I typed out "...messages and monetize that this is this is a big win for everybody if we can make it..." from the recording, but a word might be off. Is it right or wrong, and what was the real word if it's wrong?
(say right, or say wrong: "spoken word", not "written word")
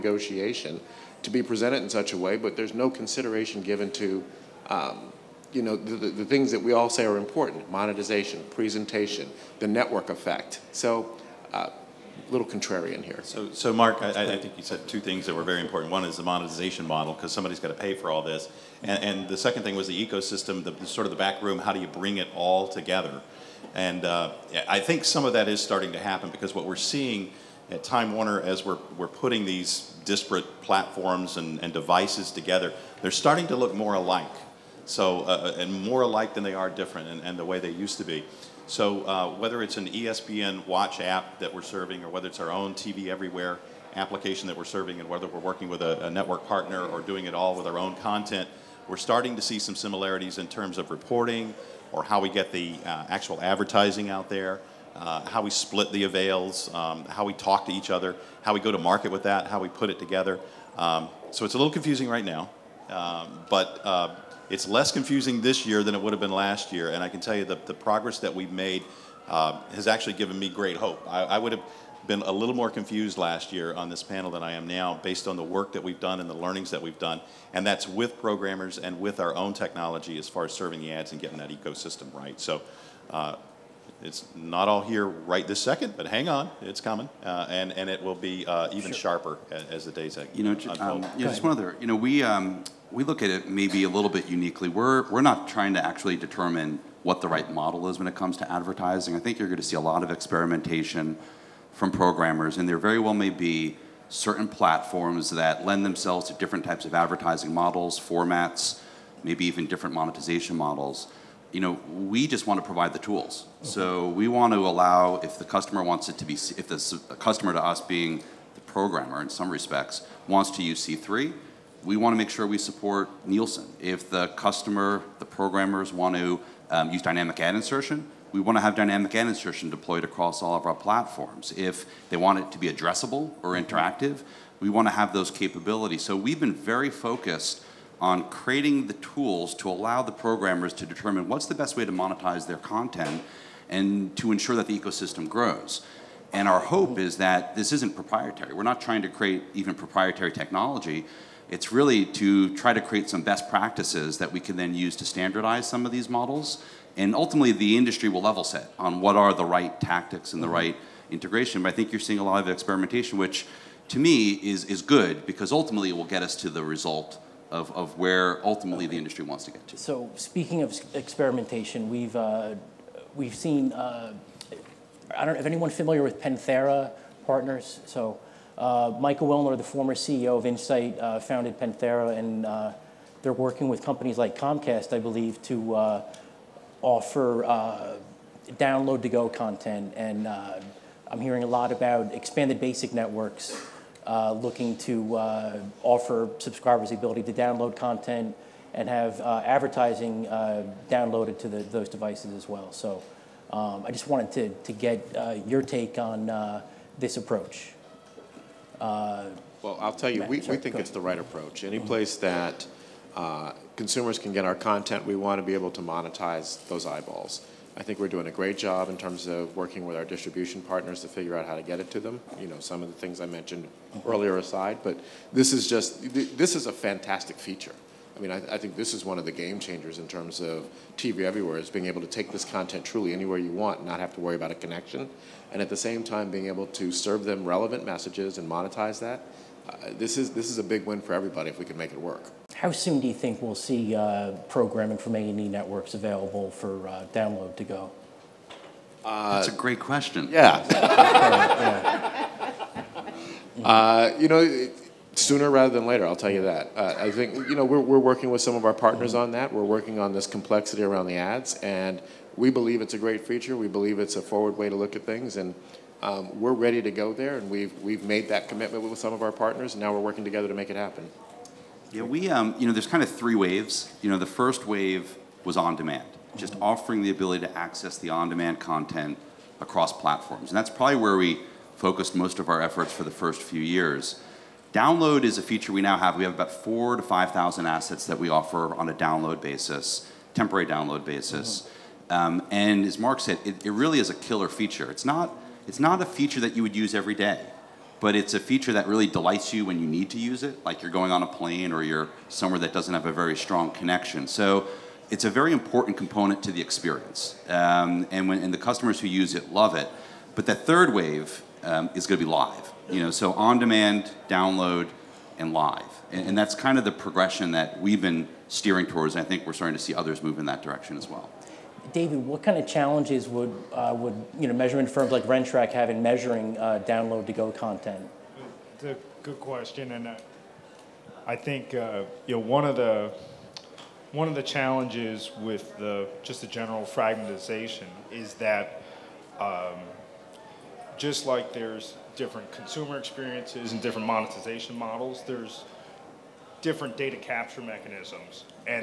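right.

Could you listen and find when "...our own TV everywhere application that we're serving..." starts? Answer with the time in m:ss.
0:42.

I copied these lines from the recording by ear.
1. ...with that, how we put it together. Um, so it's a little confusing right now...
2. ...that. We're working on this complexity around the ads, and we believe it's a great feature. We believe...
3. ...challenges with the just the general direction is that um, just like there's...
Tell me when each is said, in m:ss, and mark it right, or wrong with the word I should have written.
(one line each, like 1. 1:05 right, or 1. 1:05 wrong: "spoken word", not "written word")
1. 0:59 right
2. 4:19 right
3. 5:34 wrong: "fragmentization", not "direction".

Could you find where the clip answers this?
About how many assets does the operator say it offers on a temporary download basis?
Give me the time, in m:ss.
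4:46.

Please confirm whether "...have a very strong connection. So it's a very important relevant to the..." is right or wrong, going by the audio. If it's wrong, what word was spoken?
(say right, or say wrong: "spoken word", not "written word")
wrong: "component", not "relevant".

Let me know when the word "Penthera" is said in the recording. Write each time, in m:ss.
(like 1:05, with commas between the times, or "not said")
2:56, 3:01.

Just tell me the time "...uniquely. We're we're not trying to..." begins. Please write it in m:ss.
1:34.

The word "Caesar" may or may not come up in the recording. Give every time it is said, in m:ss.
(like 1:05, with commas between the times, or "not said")
not said.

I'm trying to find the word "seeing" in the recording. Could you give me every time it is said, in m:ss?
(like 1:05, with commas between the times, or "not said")
0:26, 2:42.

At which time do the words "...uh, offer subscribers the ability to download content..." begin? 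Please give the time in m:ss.
3:15.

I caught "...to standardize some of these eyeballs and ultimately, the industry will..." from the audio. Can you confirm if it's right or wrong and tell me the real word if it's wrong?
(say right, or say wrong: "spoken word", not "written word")
wrong: "models", not "eyeballs".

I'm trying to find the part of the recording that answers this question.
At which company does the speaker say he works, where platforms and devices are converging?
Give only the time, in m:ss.
0:27.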